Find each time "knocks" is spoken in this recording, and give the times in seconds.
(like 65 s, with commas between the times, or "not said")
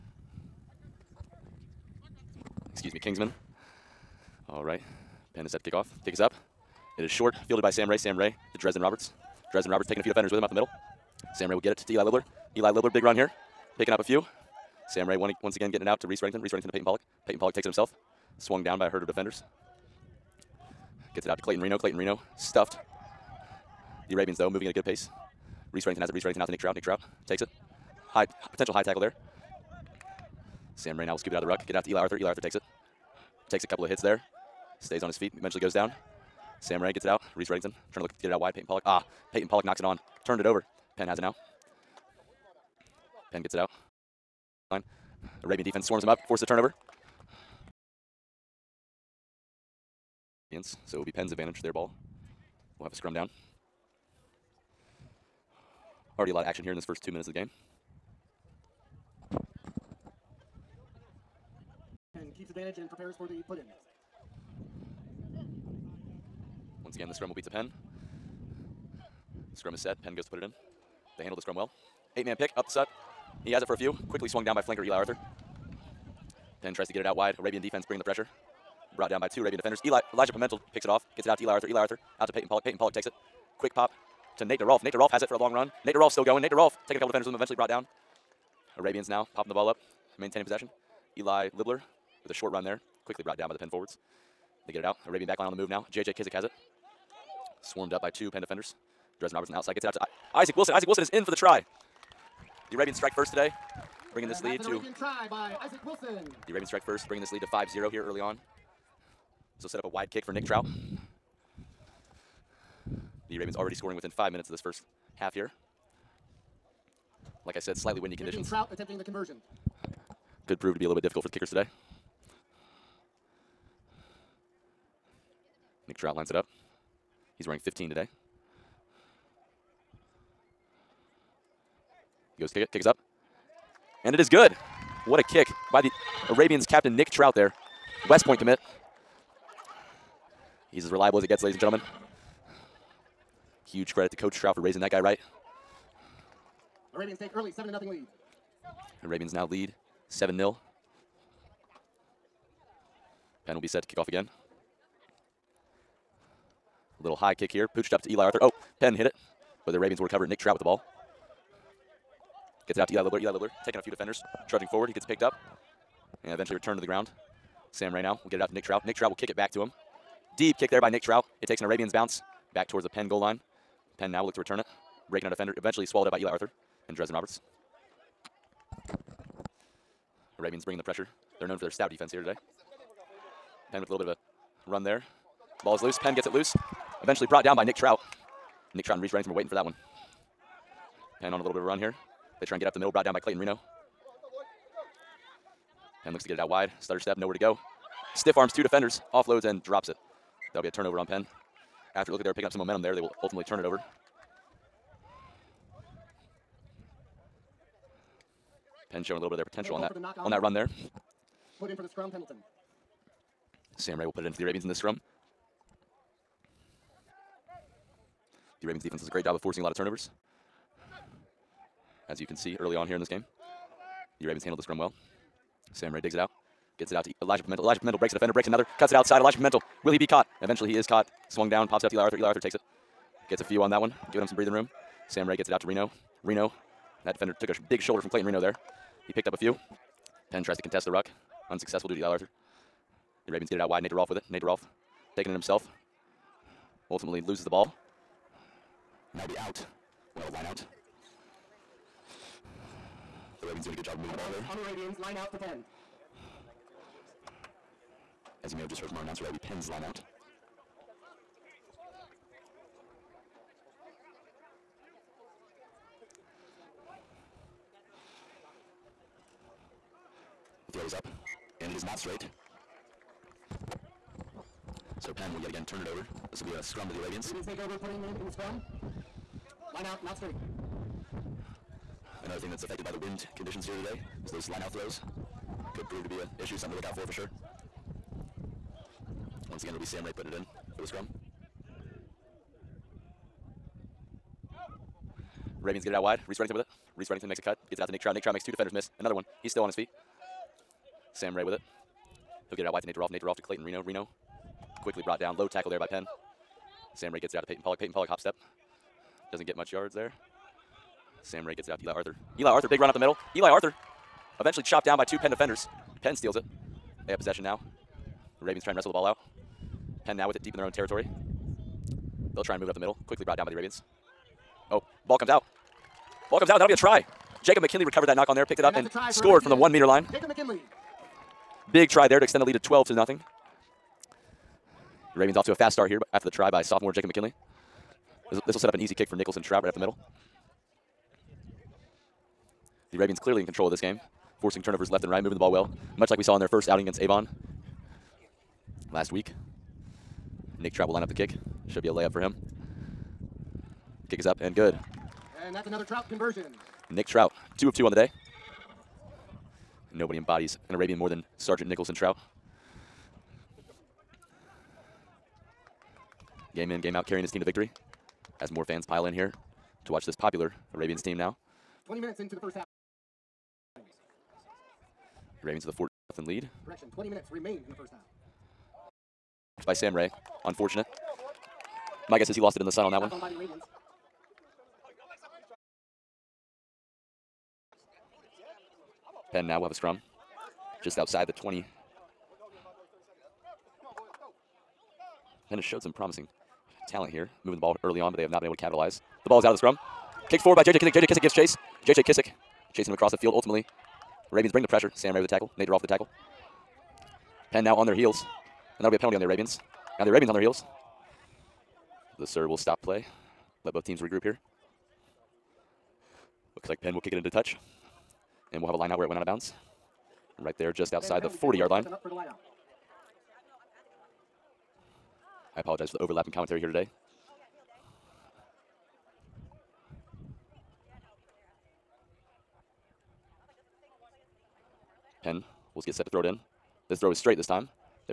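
39 s, 328 s.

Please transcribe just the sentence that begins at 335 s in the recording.
Ravens off to a fast start here but after the try by sophomore Jacob McKinley.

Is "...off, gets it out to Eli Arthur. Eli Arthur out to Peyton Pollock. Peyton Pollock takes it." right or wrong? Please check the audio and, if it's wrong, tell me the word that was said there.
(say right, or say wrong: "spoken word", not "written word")
right.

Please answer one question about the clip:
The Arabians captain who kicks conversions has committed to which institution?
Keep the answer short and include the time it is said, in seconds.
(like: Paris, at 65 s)
West Point, at 138 s.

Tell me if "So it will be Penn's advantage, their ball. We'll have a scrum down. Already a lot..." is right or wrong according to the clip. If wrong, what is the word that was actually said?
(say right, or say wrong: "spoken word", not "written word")
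right.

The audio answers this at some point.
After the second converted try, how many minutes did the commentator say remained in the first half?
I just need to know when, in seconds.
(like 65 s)
376 s.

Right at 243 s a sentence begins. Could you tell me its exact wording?
The Ravens get it out wide.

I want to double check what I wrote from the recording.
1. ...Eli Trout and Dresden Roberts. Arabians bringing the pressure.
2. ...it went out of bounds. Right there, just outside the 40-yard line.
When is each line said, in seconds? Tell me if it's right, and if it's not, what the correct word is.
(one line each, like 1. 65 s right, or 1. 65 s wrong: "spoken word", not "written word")
1. 176 s wrong: "Arthur", not "Trout"
2. 419 s right.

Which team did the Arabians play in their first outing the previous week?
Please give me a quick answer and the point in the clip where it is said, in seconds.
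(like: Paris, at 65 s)
Avon, at 347 s.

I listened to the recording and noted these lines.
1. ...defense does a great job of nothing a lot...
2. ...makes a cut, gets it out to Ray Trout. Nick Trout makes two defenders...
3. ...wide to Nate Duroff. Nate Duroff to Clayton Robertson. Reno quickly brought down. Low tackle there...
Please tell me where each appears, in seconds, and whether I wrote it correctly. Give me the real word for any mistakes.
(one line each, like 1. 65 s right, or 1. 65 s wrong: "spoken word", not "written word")
1. 218 s wrong: "forcing", not "nothing"
2. 297 s wrong: "Nick", not "Ray"
3. 302 s wrong: "Reno", not "Robertson".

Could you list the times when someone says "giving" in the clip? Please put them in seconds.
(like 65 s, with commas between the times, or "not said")
234 s.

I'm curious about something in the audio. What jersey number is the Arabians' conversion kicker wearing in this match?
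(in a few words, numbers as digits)
15.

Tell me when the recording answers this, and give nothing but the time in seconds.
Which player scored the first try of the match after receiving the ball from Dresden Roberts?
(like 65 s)
100 s.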